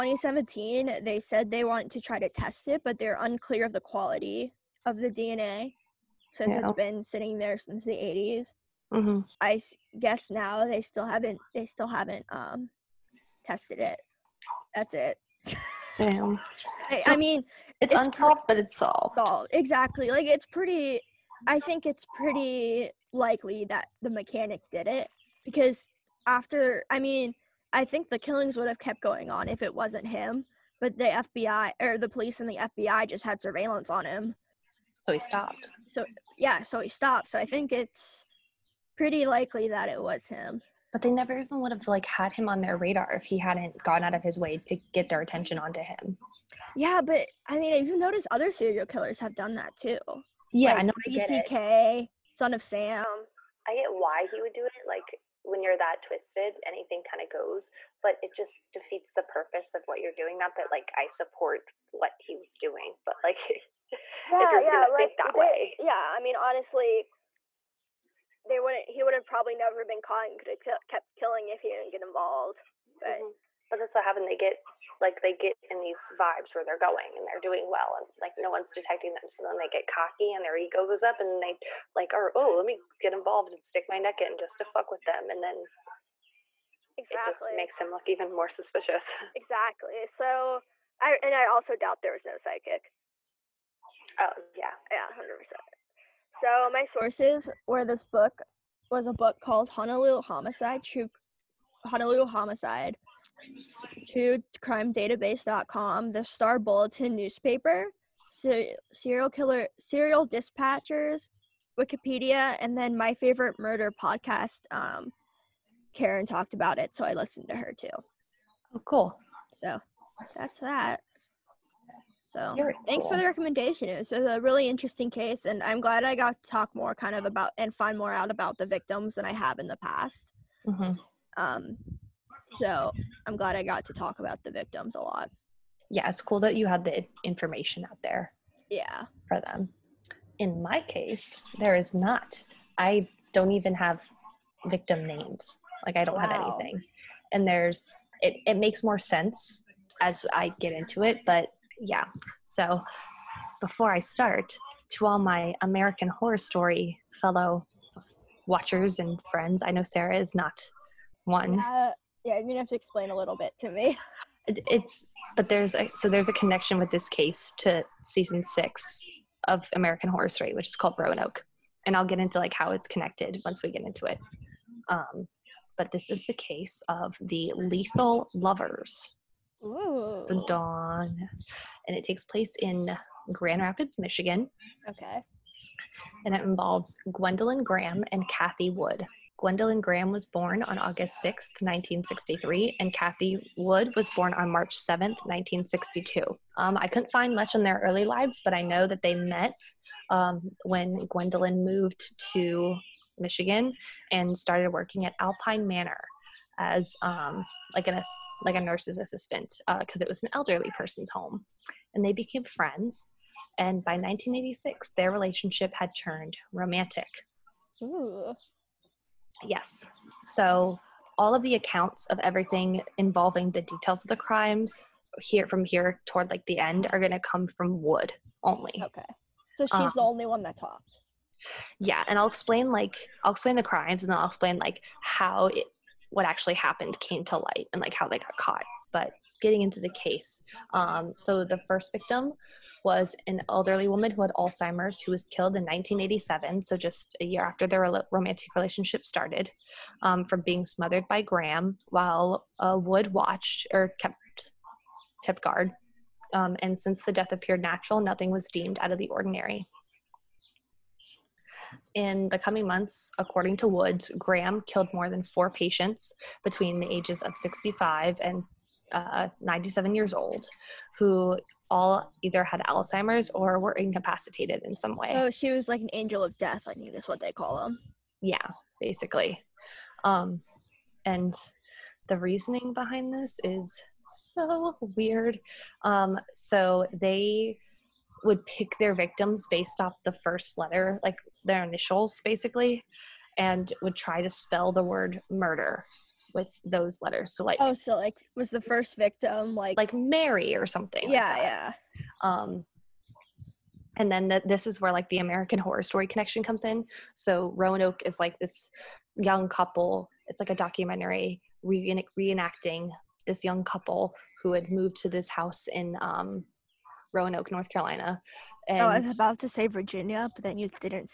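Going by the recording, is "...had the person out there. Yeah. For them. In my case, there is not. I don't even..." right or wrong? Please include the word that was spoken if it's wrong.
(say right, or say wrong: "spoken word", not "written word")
wrong: "information", not "person".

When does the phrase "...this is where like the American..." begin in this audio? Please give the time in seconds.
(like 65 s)
304 s.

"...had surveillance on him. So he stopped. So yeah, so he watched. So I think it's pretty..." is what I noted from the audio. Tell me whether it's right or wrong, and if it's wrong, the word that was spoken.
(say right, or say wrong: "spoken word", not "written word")
wrong: "stopped", not "watched".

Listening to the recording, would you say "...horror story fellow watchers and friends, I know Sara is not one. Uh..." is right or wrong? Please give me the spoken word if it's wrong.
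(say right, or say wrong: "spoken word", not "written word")
right.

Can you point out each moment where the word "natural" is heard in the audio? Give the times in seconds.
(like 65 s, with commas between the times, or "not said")
257 s.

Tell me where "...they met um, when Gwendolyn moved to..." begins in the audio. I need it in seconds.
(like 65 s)
199 s.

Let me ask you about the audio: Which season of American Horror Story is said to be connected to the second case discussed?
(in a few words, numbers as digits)
6.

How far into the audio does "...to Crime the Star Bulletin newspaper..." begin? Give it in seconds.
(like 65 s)
104 s.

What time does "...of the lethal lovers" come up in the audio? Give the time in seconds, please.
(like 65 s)
176 s.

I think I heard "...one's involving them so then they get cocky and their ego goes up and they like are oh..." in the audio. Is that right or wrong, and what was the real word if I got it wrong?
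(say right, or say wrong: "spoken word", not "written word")
wrong: "detecting", not "involving".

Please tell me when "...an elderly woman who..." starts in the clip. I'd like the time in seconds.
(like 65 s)
243 s.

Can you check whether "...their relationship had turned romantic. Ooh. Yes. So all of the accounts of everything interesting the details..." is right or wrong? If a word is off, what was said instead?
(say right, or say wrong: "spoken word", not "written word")
wrong: "involving", not "interesting".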